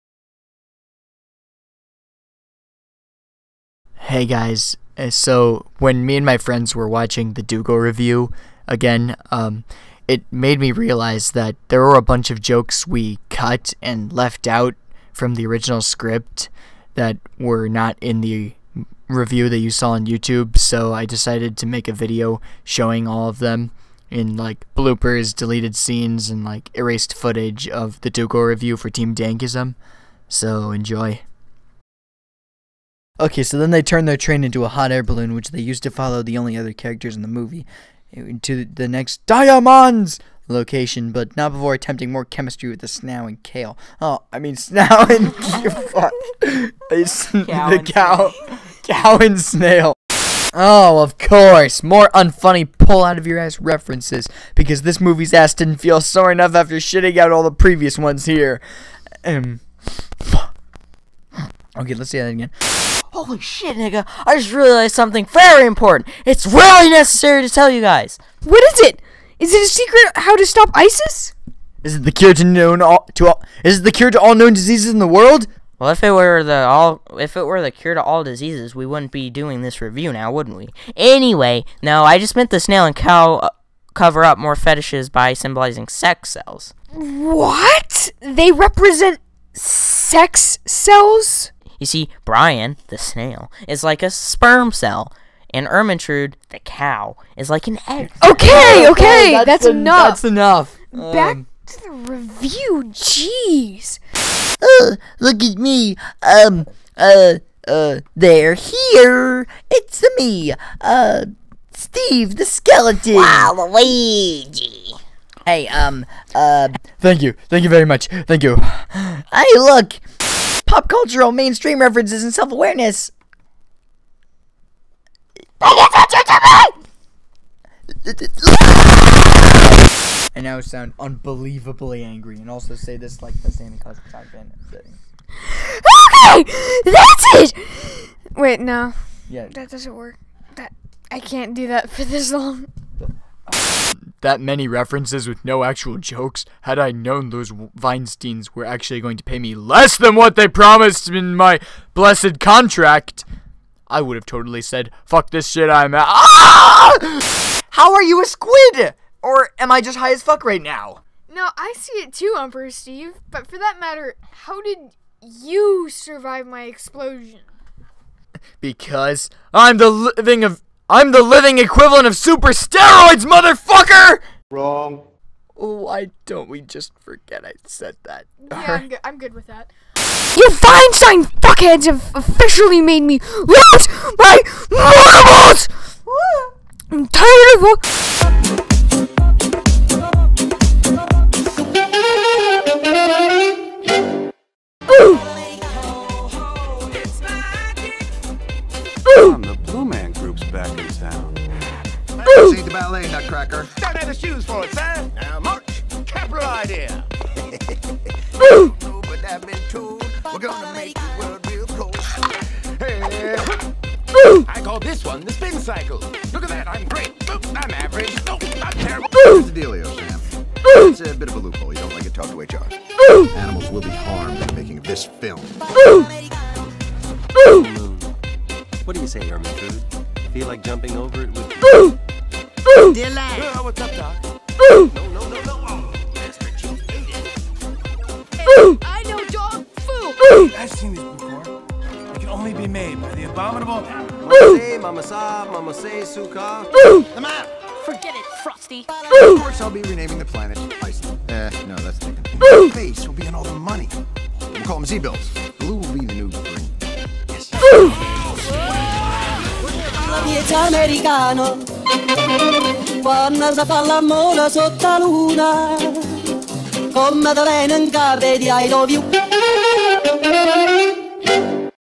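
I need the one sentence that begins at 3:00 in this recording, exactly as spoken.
You Feinstein fuckheads have officially made me lose my marbles!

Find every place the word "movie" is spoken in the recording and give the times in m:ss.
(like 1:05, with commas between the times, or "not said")
0:37, 0:54.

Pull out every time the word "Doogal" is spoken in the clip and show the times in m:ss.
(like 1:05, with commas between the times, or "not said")
0:07, 0:28.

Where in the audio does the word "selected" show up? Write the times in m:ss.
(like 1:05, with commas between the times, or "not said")
not said.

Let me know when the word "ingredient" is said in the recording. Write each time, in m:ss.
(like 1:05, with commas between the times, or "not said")
not said.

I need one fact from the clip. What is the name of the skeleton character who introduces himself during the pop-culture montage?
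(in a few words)
Steve the skeleton.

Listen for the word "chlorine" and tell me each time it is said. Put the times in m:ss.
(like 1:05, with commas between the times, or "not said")
not said.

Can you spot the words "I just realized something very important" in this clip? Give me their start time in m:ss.
1:04.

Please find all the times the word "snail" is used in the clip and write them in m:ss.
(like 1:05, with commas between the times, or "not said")
0:49, 1:22, 1:32.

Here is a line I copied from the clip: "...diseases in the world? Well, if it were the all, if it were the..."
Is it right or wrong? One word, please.
right.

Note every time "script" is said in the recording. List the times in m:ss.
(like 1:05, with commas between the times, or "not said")
0:15.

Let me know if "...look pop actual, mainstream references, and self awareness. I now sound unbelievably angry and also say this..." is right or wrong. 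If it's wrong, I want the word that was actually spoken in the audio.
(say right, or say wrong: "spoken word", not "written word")
wrong: "cultural", not "actual".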